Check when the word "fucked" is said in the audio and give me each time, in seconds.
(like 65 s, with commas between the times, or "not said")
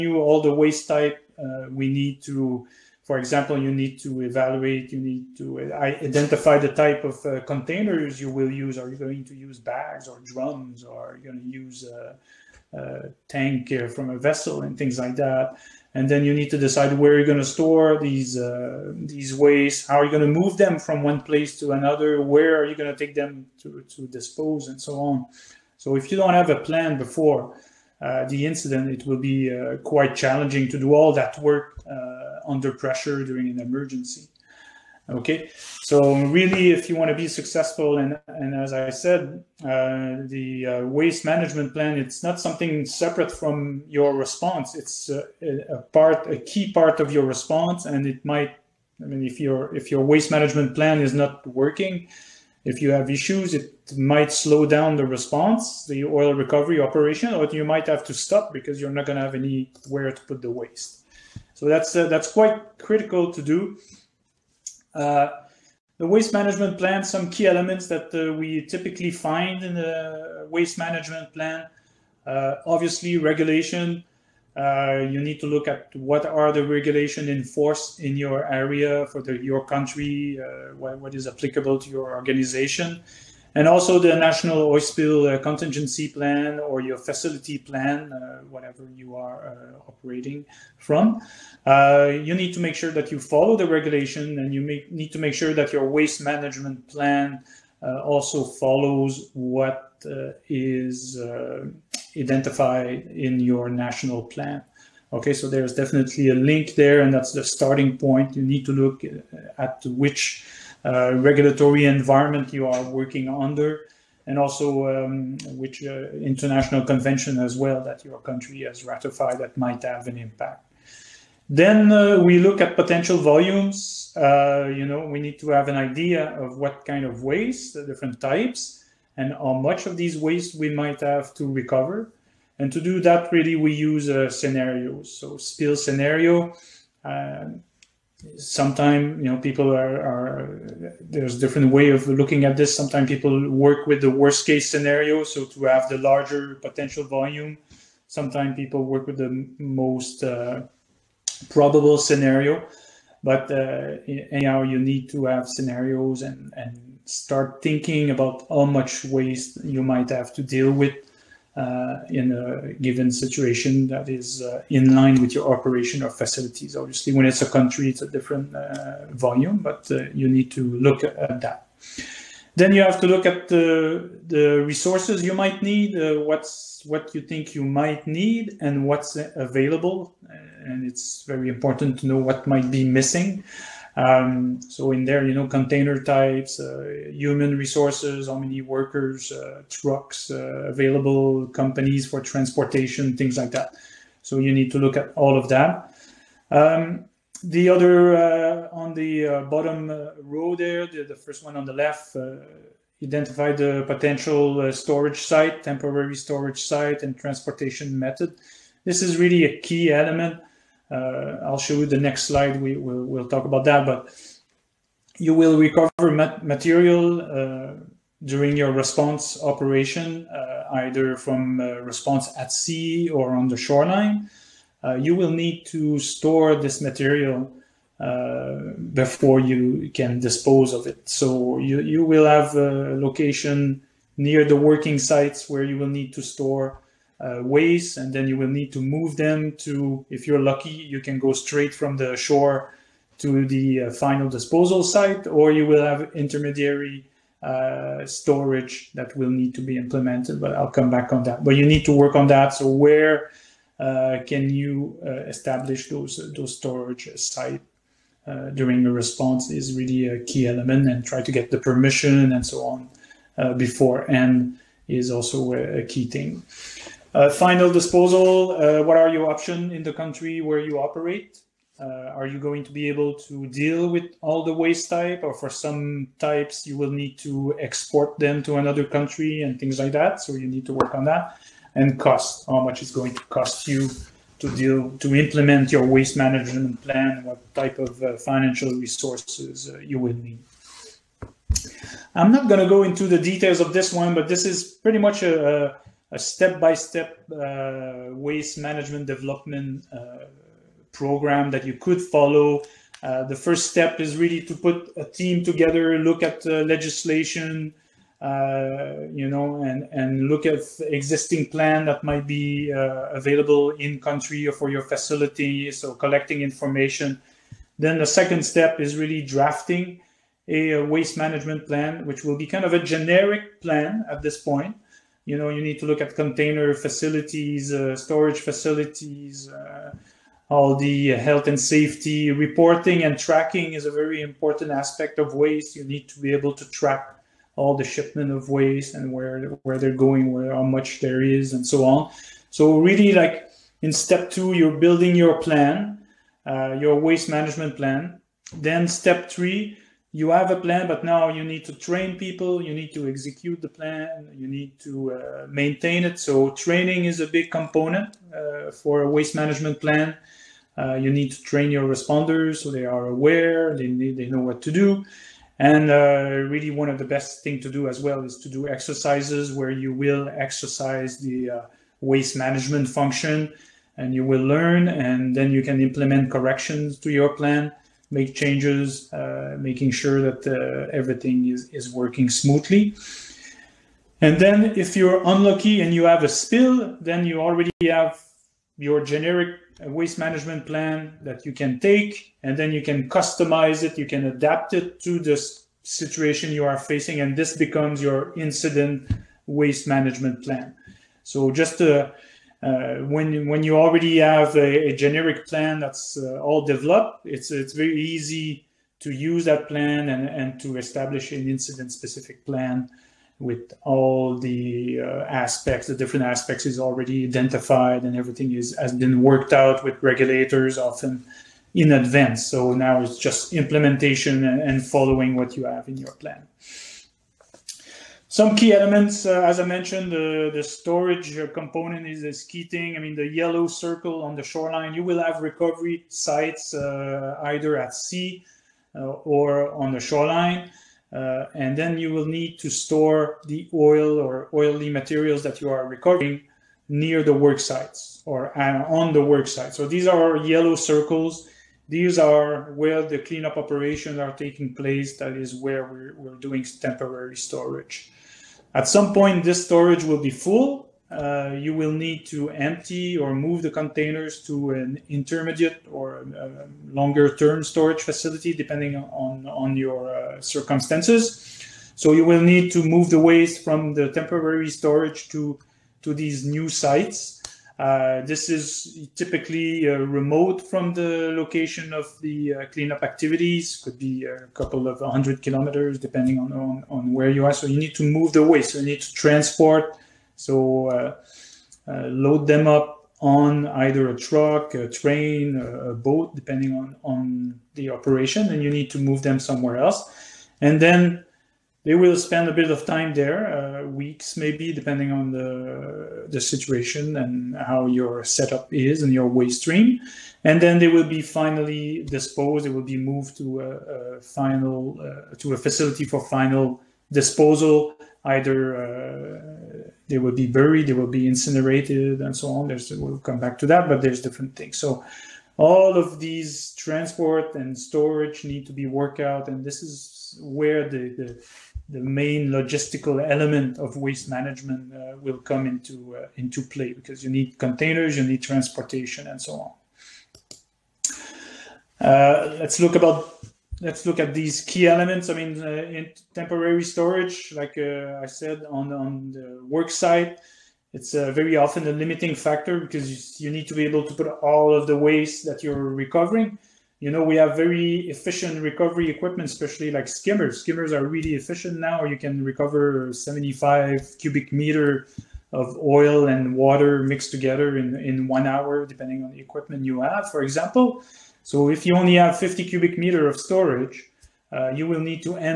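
not said.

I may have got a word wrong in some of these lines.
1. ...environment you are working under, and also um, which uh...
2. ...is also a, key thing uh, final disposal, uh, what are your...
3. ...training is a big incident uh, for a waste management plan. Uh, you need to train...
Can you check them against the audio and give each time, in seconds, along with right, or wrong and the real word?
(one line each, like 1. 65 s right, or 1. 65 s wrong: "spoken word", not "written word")
1. 111 s right
2. 264 s right
3. 356 s wrong: "component", not "incident".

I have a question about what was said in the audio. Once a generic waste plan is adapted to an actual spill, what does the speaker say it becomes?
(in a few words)
Incident waste management plan.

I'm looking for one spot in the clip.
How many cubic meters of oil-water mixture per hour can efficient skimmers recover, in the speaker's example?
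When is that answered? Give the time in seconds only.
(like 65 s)
563 s.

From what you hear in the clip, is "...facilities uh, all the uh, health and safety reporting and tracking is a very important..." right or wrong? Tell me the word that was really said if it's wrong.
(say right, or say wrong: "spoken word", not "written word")
right.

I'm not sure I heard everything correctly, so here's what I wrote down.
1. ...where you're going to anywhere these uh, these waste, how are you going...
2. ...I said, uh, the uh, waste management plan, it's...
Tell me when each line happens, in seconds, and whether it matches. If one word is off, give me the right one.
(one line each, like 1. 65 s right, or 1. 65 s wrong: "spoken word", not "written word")
1. 16 s wrong: "store", not "anywhere"
2. 38 s right.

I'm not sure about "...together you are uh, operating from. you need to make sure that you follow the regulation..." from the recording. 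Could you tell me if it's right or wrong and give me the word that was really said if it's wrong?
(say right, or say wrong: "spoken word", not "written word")
wrong: "whatever", not "together".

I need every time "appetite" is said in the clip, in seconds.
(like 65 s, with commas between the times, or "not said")
not said.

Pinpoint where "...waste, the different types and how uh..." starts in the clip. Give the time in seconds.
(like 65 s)
127 s.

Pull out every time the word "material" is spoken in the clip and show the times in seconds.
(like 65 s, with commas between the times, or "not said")
216 s, 226 s, 444 s.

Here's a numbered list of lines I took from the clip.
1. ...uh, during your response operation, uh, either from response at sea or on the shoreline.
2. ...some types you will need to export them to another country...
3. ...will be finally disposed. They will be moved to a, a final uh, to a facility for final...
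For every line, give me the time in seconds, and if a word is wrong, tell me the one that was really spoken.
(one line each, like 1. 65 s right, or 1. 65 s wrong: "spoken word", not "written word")
1. 217 s right
2. 275 s right
3. 510 s right.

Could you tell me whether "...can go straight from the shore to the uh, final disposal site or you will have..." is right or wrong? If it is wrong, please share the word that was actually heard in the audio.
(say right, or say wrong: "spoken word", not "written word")
right.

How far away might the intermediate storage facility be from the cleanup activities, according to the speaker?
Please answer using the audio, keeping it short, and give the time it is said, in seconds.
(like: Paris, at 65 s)
A couple of 100 kilometers, at 484 s.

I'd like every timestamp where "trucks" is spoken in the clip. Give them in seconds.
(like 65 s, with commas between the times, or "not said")
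189 s, 494 s.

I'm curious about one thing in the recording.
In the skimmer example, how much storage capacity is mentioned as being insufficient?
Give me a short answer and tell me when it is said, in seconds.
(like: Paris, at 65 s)
50 cubic meters, at 572 s.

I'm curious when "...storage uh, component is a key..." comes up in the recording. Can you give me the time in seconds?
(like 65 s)
430 s.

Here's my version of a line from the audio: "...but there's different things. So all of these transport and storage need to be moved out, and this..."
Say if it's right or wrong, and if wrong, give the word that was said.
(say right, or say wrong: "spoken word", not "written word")
wrong: "worked", not "moved".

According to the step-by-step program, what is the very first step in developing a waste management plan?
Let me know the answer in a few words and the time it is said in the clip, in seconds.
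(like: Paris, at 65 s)
Put a team together, at 304 s.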